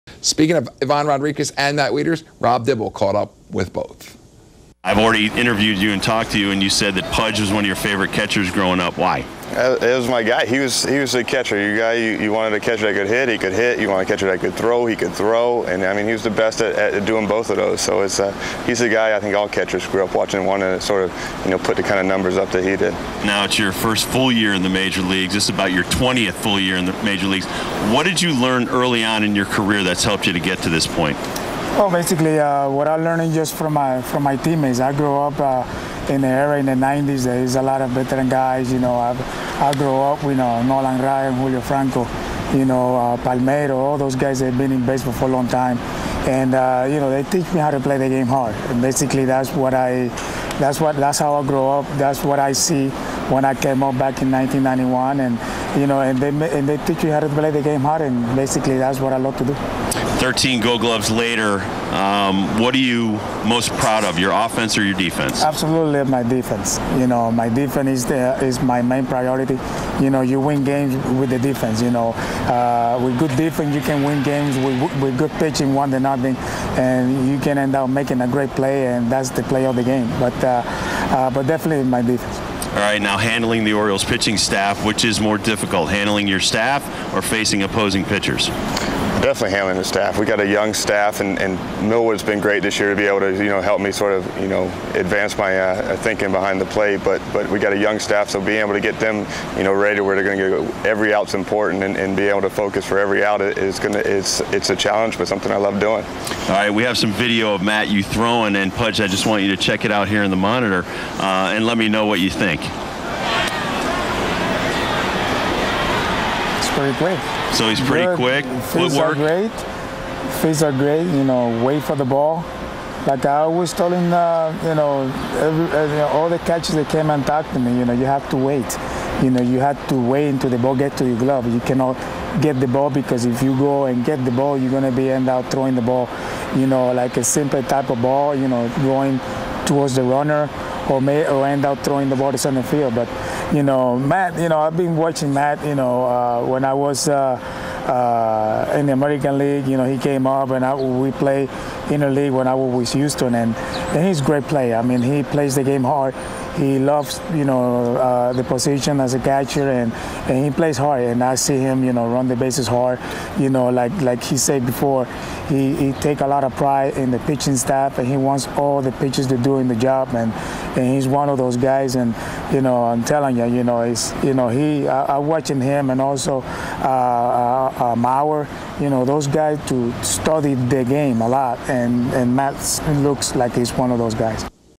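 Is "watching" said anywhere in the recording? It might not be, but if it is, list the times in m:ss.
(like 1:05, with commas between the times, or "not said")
0:20, 2:24, 2:55.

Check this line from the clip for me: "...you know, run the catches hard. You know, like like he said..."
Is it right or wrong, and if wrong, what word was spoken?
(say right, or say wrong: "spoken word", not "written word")
wrong: "bases", not "catches".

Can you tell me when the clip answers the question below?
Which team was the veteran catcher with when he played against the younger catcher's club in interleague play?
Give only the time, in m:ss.
2:32.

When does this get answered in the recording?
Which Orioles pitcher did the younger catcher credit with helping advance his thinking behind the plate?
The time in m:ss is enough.
1:31.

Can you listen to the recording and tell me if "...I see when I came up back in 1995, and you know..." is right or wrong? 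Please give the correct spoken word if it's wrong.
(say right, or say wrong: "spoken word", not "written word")
wrong: "1991", not "1995".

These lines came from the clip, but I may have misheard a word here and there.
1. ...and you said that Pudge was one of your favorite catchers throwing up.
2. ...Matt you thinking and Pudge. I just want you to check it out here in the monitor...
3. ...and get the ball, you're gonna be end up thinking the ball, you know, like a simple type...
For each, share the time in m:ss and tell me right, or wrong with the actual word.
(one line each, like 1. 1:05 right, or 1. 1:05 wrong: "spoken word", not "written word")
1. 0:06 wrong: "growing", not "throwing"
2. 1:47 wrong: "throwing", not "thinking"
3. 2:13 wrong: "throwing", not "thinking".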